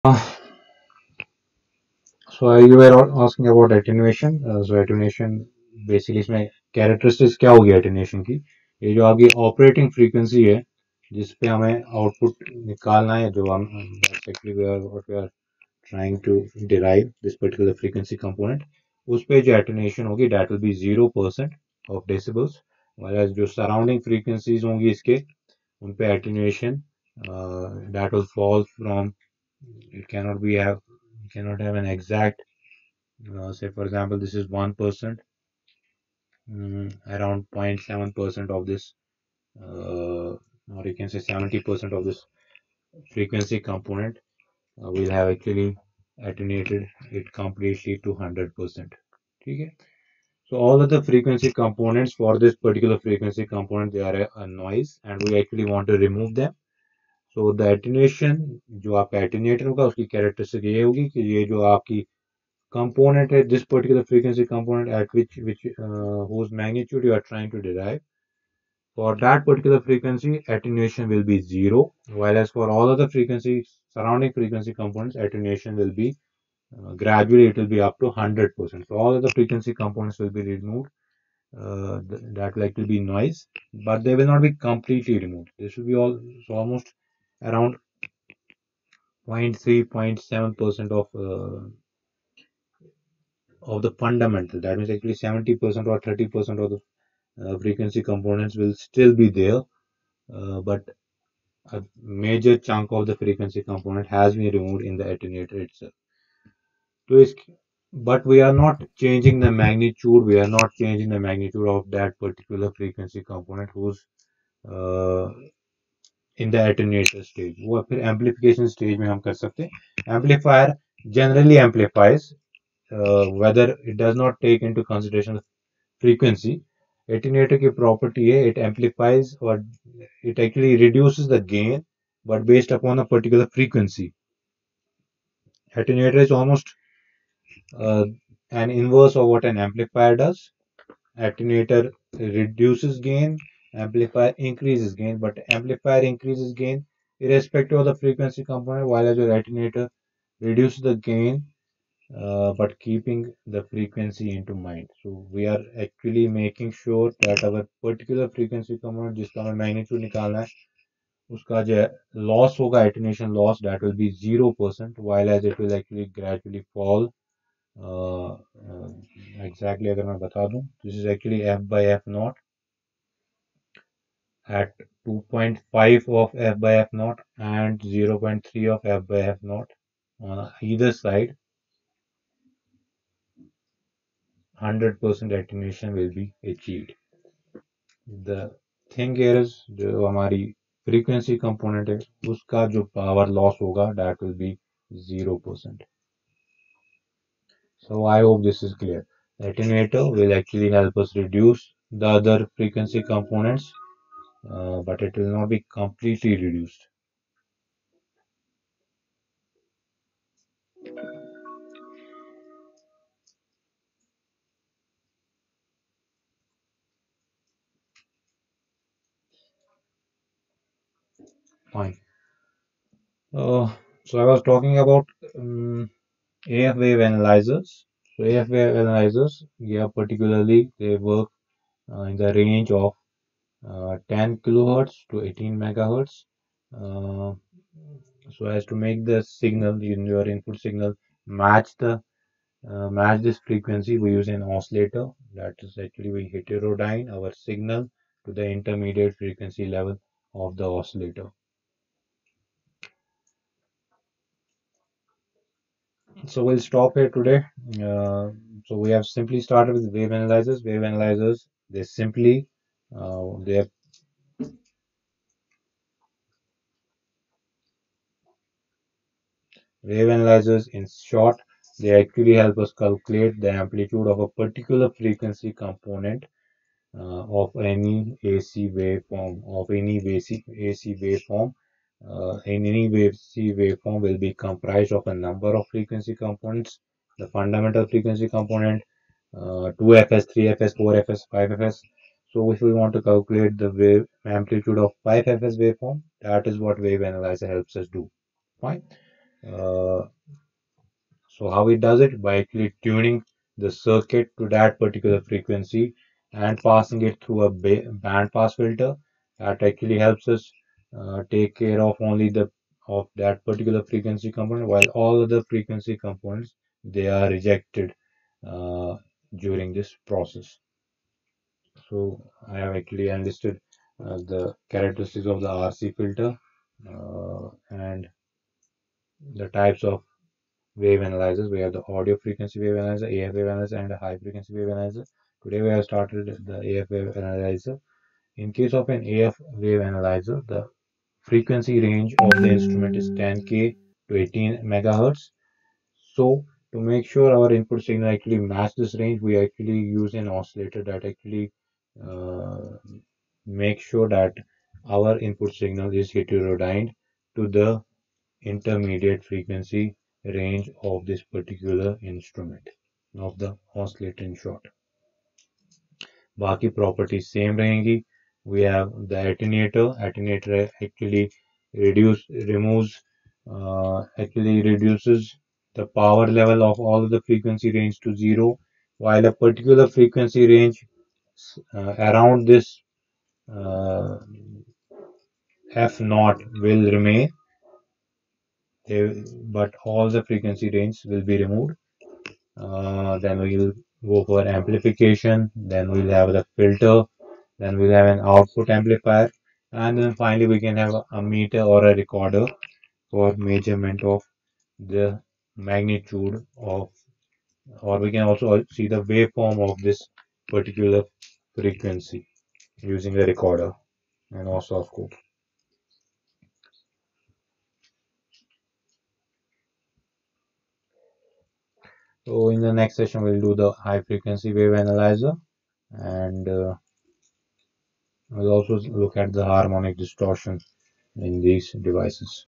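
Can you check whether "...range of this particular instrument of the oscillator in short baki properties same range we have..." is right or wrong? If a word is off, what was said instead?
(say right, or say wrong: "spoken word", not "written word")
right.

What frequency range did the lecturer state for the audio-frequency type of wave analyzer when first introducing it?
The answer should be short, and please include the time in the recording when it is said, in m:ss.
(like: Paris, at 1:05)
10 kHz to 18 MHz, at 3:54.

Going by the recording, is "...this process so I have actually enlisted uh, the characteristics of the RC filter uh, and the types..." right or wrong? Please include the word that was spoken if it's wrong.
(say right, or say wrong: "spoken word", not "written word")
right.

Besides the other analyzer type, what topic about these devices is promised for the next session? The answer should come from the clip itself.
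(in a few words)
Harmonic distortion.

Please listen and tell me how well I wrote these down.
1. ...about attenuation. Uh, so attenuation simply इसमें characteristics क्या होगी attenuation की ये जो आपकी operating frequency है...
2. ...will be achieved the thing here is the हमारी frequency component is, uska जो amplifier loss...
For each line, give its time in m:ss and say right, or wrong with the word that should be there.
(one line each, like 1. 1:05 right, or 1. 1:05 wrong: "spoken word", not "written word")
1. 0:03 wrong: "basically", not "simply"
2. 3:05 wrong: "power", not "amplifier".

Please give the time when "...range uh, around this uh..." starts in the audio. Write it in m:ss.
6:20.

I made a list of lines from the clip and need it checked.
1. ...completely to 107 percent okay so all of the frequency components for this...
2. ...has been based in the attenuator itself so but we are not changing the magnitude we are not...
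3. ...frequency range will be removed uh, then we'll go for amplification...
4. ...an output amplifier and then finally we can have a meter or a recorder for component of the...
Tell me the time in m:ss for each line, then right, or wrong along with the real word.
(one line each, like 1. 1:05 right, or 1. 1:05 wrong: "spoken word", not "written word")
1. 0:47 wrong: "100", not "107"
2. 1:44 wrong: "removed", not "based"
3. 6:30 right
4. 6:38 wrong: "measurement", not "component".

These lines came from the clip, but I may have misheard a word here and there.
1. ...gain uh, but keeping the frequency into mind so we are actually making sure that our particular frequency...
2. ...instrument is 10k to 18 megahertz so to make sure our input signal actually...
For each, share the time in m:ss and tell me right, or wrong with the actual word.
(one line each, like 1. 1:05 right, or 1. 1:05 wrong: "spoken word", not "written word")
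1. 2:30 right
2. 5:42 right.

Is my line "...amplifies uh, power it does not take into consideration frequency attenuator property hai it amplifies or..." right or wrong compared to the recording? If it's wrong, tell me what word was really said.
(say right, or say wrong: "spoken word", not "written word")
wrong: "whether", not "power".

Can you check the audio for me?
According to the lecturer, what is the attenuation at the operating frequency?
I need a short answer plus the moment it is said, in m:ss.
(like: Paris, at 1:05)
0 percent, at 0:20.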